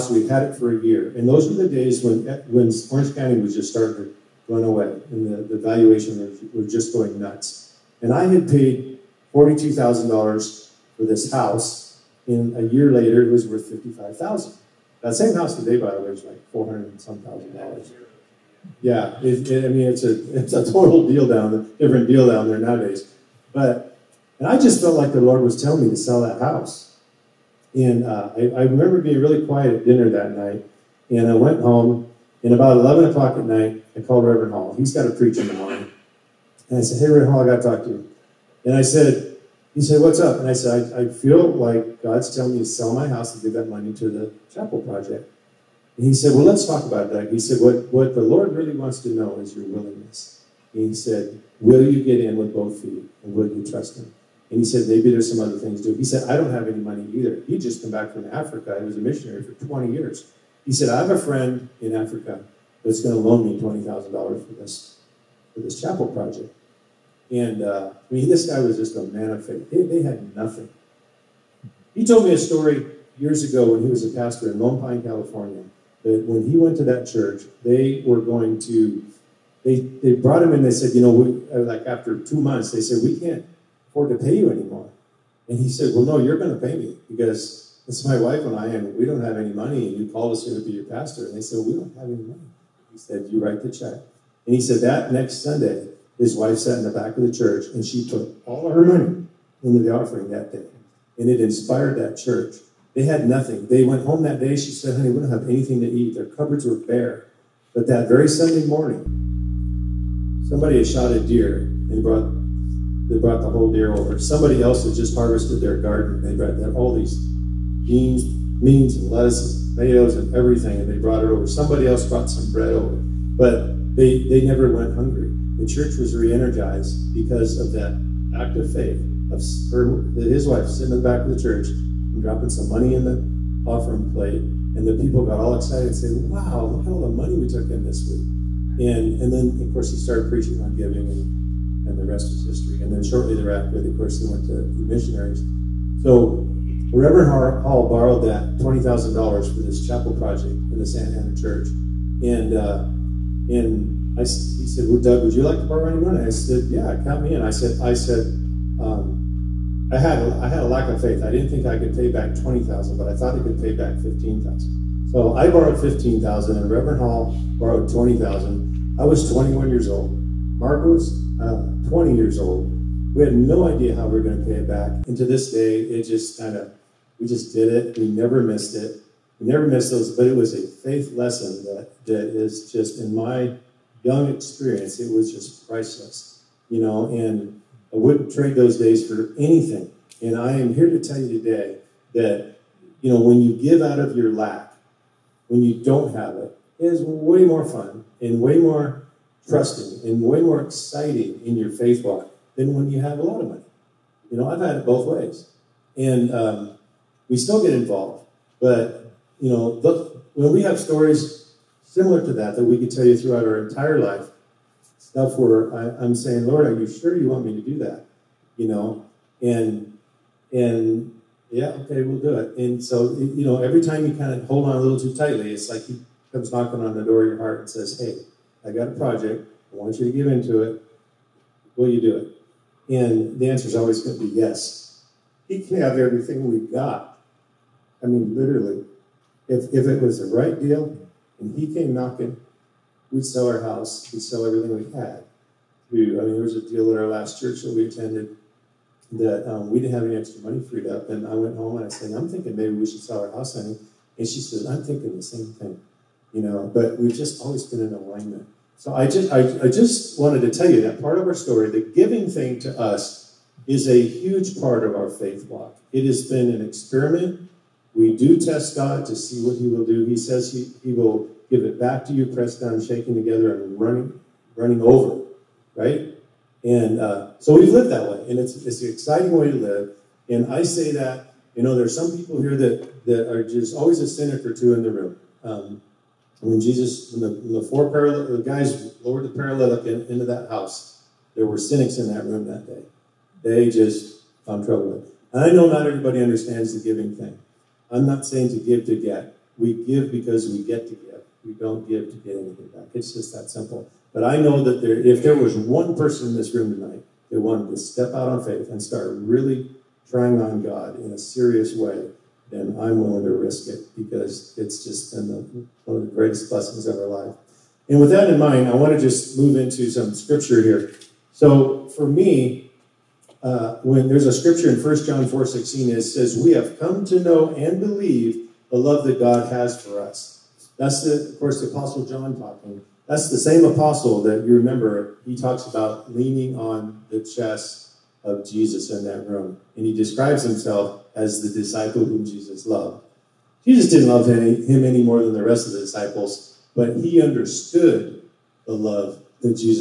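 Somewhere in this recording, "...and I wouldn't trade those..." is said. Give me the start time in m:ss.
3:07.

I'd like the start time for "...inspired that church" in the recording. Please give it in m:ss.
1:41.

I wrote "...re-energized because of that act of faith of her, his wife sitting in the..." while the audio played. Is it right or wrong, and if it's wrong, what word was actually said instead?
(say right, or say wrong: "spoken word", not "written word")
right.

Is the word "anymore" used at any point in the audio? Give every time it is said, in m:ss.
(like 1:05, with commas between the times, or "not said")
1:24.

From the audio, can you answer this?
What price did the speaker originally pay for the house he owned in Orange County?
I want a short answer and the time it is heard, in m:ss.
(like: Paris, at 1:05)
$42,000, at 0:09.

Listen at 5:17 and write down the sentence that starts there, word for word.
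And with that in mind, I want to just move into some scripture here.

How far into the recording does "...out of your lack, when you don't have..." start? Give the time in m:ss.
3:13.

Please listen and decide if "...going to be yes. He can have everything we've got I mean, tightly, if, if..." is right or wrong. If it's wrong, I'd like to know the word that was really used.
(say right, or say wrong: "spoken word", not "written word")
wrong: "literally", not "tightly".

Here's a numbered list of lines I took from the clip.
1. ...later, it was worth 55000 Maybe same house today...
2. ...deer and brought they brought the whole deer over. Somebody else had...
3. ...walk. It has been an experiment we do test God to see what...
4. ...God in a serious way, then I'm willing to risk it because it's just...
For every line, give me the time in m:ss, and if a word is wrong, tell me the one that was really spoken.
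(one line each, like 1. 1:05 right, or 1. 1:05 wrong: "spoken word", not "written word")
1. 0:12 wrong: "That", not "Maybe"
2. 1:51 right
3. 4:25 right
4. 5:10 right.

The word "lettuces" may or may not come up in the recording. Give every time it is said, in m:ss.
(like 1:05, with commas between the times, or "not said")
1:59.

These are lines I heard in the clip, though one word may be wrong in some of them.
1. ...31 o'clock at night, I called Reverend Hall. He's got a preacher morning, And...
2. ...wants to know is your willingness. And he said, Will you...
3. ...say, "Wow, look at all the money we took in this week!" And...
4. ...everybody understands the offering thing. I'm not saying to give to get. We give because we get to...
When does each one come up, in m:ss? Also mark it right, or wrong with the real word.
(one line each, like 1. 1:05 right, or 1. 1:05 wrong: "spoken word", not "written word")
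1. 0:32 wrong: "11", not "31"
2. 0:48 right
3. 2:15 right
4. 4:55 wrong: "giving", not "offering".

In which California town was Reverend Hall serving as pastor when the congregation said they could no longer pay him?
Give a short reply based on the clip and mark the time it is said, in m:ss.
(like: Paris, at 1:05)
Lone Pine, at 1:14.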